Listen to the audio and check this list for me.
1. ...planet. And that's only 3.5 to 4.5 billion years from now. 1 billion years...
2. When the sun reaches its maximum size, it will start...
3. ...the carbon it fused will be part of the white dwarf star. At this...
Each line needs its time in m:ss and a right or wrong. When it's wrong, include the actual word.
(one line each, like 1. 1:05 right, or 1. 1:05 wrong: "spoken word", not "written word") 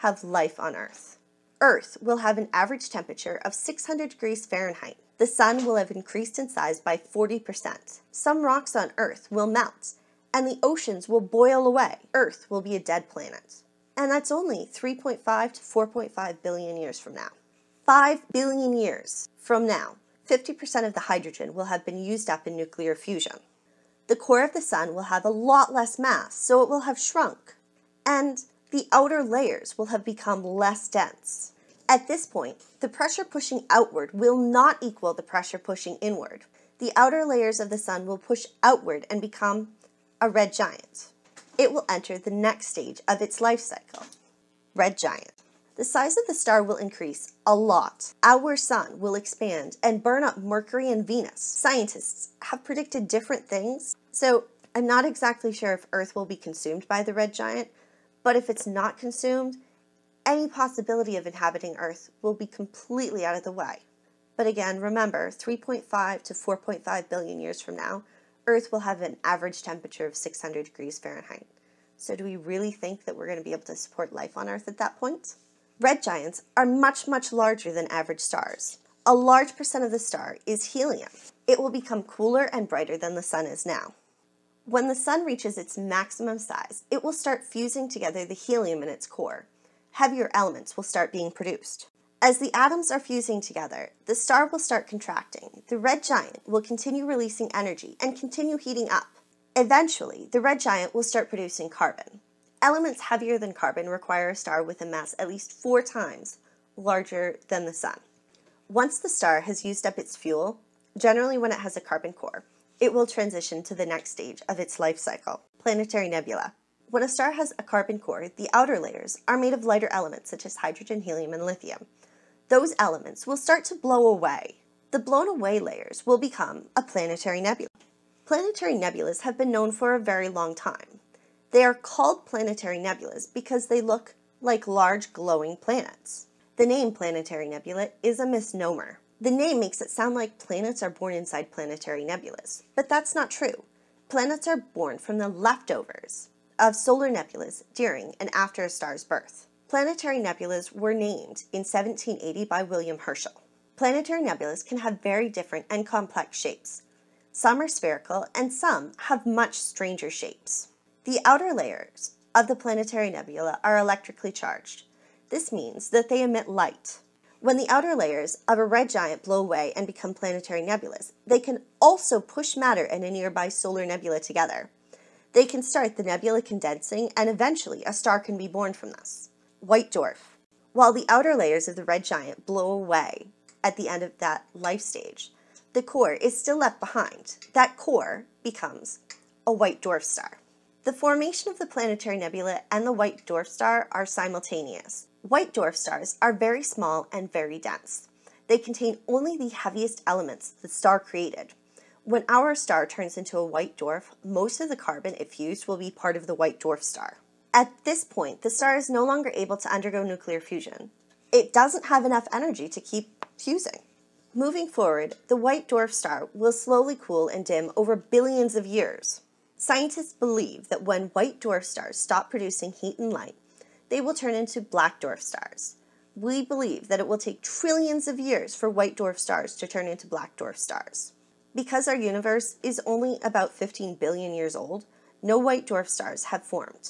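1. 0:13 wrong: "5", not "1"
2. 1:24 right
3. 3:24 right.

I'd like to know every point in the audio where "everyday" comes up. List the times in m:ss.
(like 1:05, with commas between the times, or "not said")
not said.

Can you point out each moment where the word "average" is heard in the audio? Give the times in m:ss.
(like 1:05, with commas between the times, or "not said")
0:02, 1:09, 1:17.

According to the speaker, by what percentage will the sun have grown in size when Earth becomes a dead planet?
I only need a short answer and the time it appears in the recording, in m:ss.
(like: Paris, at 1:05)
40%, at 0:06.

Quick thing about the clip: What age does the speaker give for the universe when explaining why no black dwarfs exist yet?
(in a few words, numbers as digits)
15 billion years.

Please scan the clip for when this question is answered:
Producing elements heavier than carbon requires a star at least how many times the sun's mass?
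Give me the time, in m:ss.
1:45.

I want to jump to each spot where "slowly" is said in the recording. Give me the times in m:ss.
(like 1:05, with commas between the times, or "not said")
3:36.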